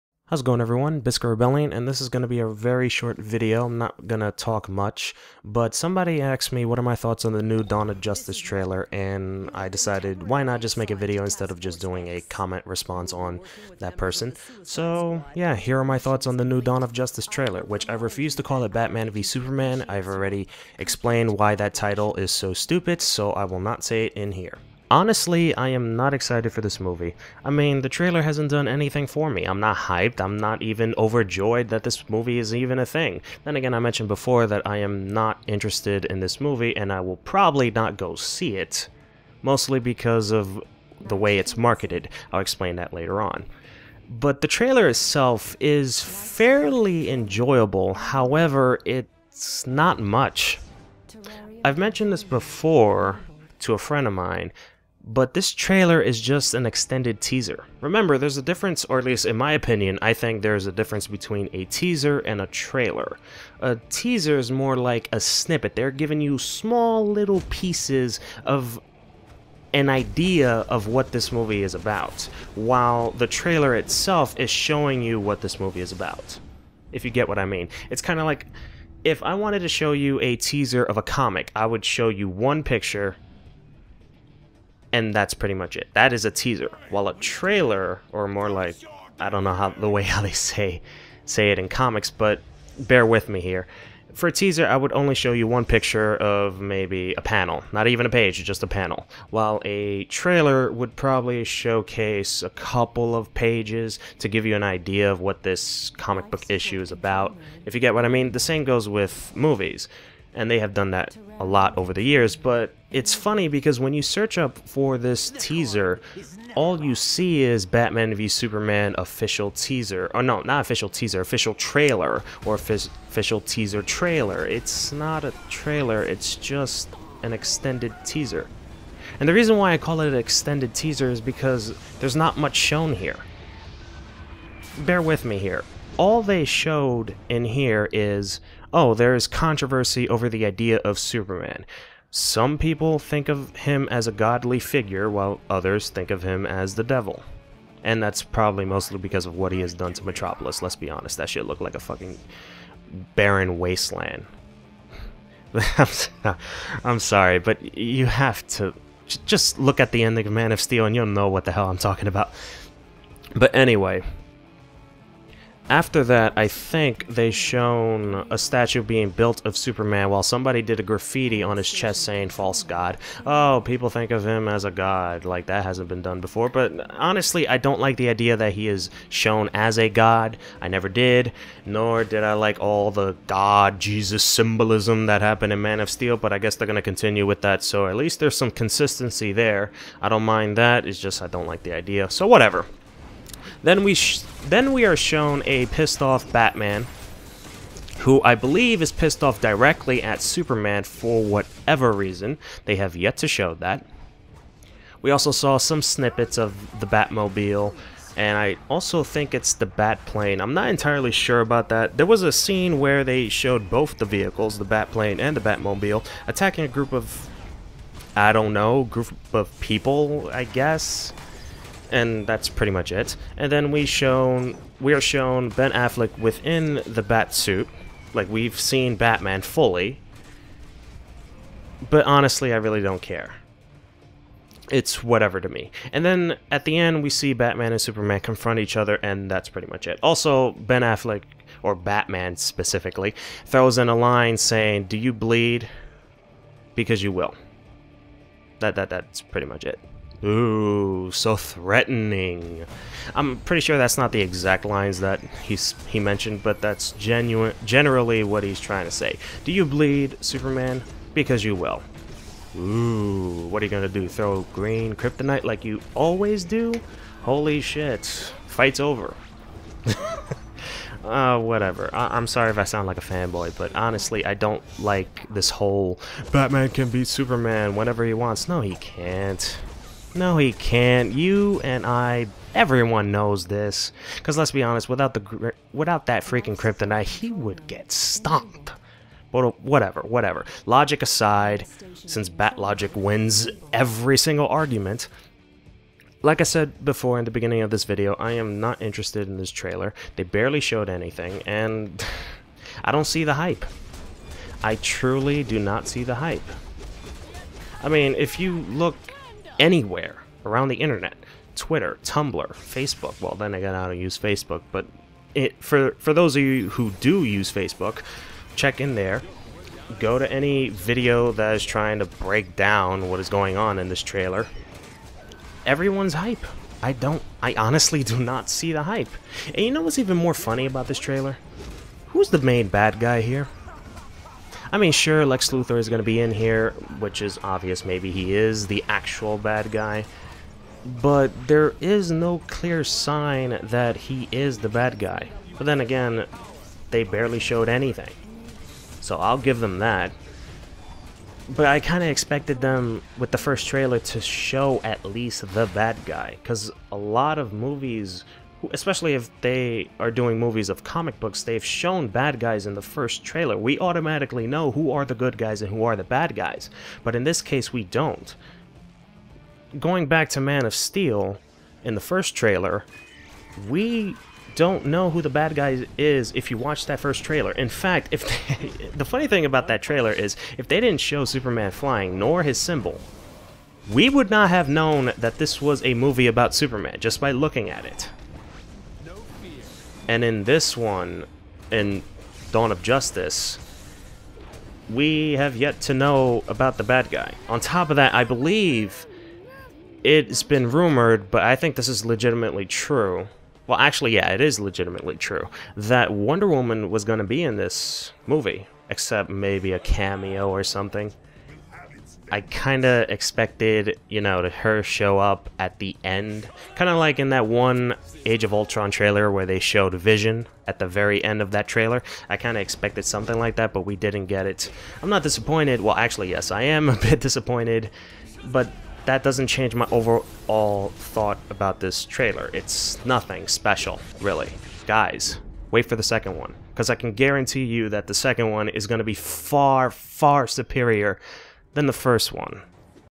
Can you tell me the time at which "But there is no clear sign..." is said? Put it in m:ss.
5:41.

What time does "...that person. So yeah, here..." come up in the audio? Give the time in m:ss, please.
0:13.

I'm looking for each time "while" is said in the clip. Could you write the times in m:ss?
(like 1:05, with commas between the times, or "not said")
1:12, 1:26, 1:39, 2:25, 2:50.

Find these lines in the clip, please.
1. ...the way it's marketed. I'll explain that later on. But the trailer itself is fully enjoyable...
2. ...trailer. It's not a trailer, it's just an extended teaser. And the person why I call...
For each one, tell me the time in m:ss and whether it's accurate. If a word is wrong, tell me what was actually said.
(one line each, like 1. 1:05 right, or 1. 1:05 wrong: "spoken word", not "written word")
1. 0:40 wrong: "fairly", not "fully"
2. 2:03 wrong: "reason", not "person".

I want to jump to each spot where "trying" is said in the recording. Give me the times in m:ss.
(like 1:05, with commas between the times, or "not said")
4:18, 5:21.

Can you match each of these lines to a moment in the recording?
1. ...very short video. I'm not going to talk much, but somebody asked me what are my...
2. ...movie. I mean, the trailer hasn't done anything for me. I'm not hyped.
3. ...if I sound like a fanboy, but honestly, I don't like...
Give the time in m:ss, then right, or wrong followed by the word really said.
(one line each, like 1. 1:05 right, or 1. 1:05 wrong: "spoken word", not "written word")
1. 0:02 right
2. 0:26 right
3. 4:32 right.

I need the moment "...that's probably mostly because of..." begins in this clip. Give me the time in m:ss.
2:28.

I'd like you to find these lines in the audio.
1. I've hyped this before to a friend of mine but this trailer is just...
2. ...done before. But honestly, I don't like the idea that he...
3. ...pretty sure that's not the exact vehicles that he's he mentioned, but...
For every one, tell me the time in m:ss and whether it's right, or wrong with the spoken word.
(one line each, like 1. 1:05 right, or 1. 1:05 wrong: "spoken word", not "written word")
1. 0:51 wrong: "mentioned", not "hyped"
2. 2:56 right
3. 4:13 wrong: "lines", not "vehicles".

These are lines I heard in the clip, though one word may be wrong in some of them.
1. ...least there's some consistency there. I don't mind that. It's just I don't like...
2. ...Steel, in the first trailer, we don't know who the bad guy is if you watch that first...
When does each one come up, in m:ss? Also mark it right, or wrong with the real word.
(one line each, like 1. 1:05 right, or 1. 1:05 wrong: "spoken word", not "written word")
1. 3:07 right
2. 6:10 right.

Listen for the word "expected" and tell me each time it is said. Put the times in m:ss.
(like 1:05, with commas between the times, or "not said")
5:52, 6:53, 7:02.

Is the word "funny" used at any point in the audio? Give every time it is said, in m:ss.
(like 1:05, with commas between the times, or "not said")
1:53, 5:30, 6:19.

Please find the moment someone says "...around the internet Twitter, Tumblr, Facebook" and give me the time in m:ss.
5:10.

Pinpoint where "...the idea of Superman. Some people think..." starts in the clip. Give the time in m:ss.
2:20.